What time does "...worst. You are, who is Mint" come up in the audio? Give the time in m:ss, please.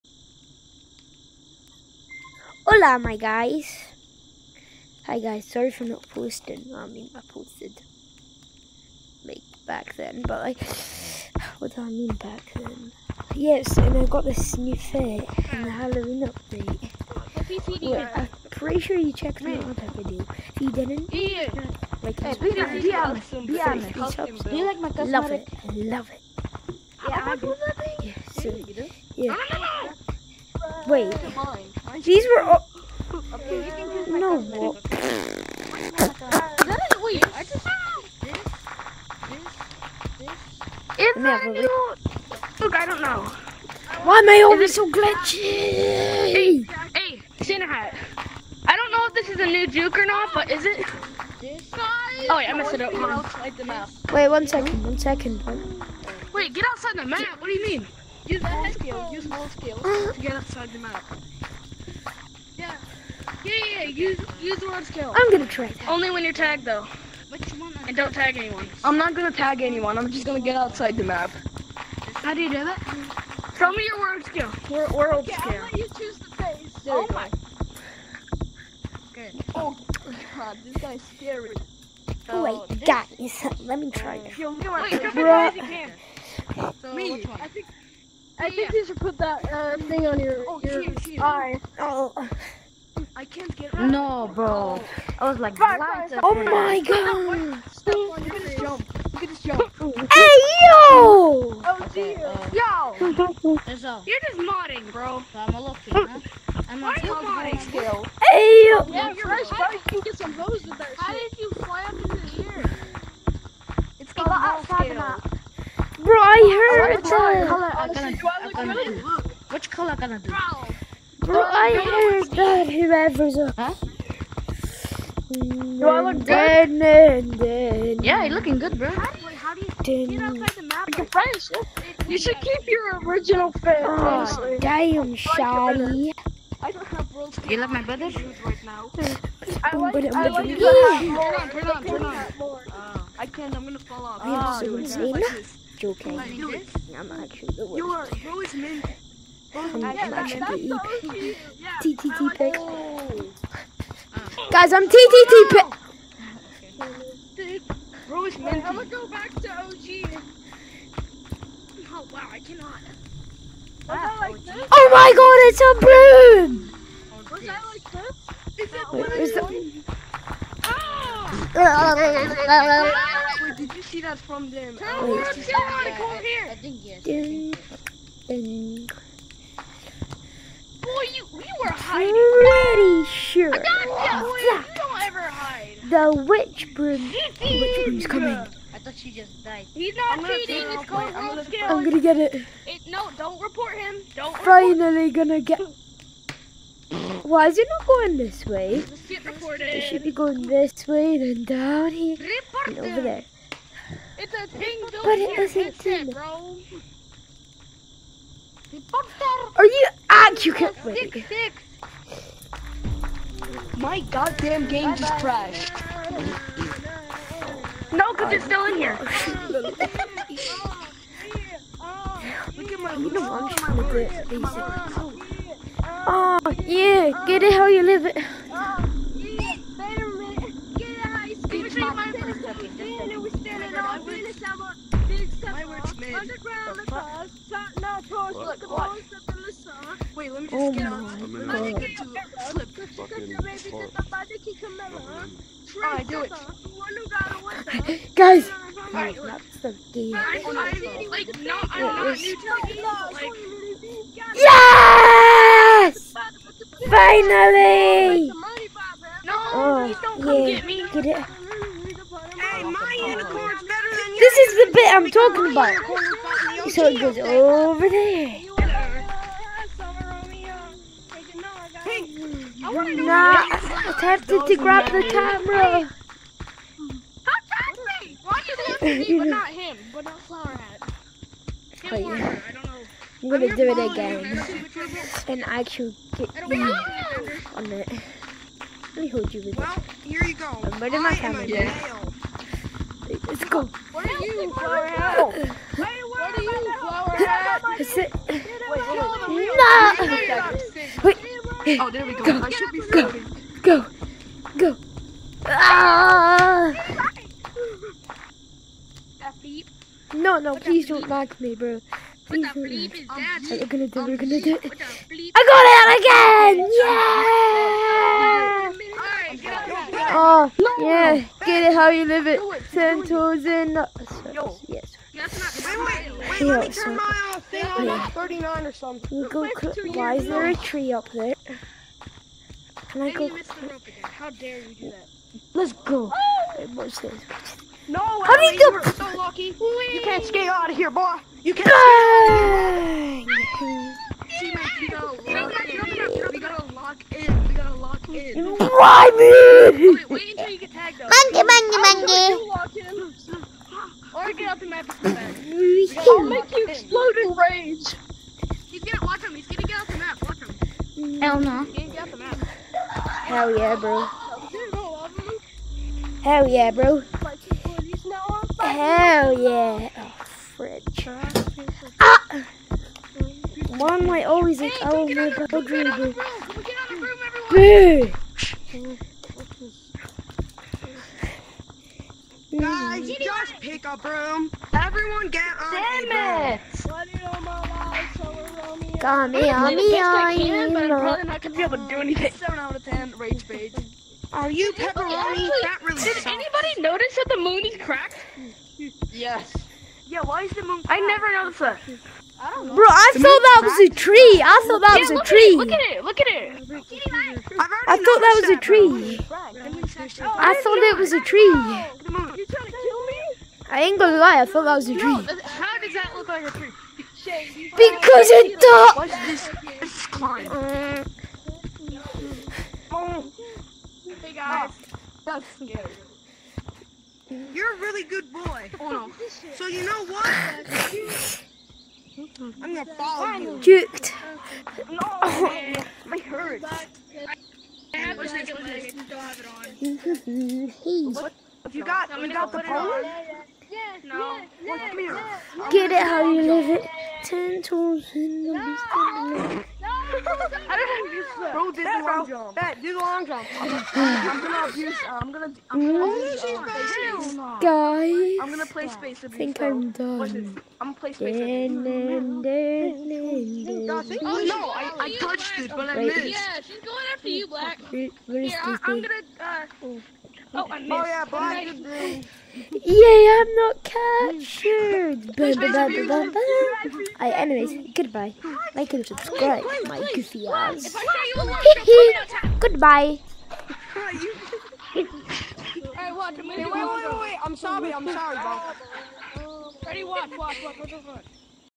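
2:27.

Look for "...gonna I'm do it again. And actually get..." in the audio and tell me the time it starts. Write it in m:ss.
4:43.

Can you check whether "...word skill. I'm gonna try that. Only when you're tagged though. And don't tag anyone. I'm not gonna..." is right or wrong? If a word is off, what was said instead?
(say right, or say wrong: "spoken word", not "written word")
right.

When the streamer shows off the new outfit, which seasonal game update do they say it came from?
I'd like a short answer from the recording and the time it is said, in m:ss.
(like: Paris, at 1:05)
Halloween update, at 0:15.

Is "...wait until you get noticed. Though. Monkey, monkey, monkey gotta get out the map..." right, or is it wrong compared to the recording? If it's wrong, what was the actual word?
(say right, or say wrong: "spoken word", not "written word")
wrong: "tagged", not "noticed".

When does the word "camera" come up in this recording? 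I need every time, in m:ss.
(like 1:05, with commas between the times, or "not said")
4:35, 4:51.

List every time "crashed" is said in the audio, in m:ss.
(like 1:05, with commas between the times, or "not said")
3:35.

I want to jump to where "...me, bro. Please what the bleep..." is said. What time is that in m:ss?
5:11.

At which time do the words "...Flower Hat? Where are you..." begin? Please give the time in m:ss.
4:54.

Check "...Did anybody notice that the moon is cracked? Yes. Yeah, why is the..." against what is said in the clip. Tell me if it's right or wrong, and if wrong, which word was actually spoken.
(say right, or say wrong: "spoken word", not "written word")
right.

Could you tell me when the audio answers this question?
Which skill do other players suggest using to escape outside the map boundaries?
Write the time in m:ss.
0:59.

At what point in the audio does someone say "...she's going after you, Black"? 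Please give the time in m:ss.
7:46.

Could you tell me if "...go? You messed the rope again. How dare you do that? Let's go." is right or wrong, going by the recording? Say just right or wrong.
wrong.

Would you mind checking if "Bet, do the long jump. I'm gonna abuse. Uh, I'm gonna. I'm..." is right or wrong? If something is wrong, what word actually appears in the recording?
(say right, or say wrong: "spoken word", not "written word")
right.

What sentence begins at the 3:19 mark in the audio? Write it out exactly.
It should be going this way, then down here, and over there.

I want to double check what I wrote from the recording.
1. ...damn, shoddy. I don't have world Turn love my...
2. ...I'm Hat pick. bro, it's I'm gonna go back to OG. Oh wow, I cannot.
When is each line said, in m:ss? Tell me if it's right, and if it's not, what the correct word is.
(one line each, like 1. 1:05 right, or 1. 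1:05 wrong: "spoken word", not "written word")
1. 2:14 wrong: "You", not "Turn"
2. 2:34 wrong: "TTT", not "Hat".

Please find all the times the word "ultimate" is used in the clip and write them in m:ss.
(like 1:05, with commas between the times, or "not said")
not said.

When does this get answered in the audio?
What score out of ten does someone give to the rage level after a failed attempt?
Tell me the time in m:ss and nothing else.
6:32.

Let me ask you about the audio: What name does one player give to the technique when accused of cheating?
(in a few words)
rogue skill.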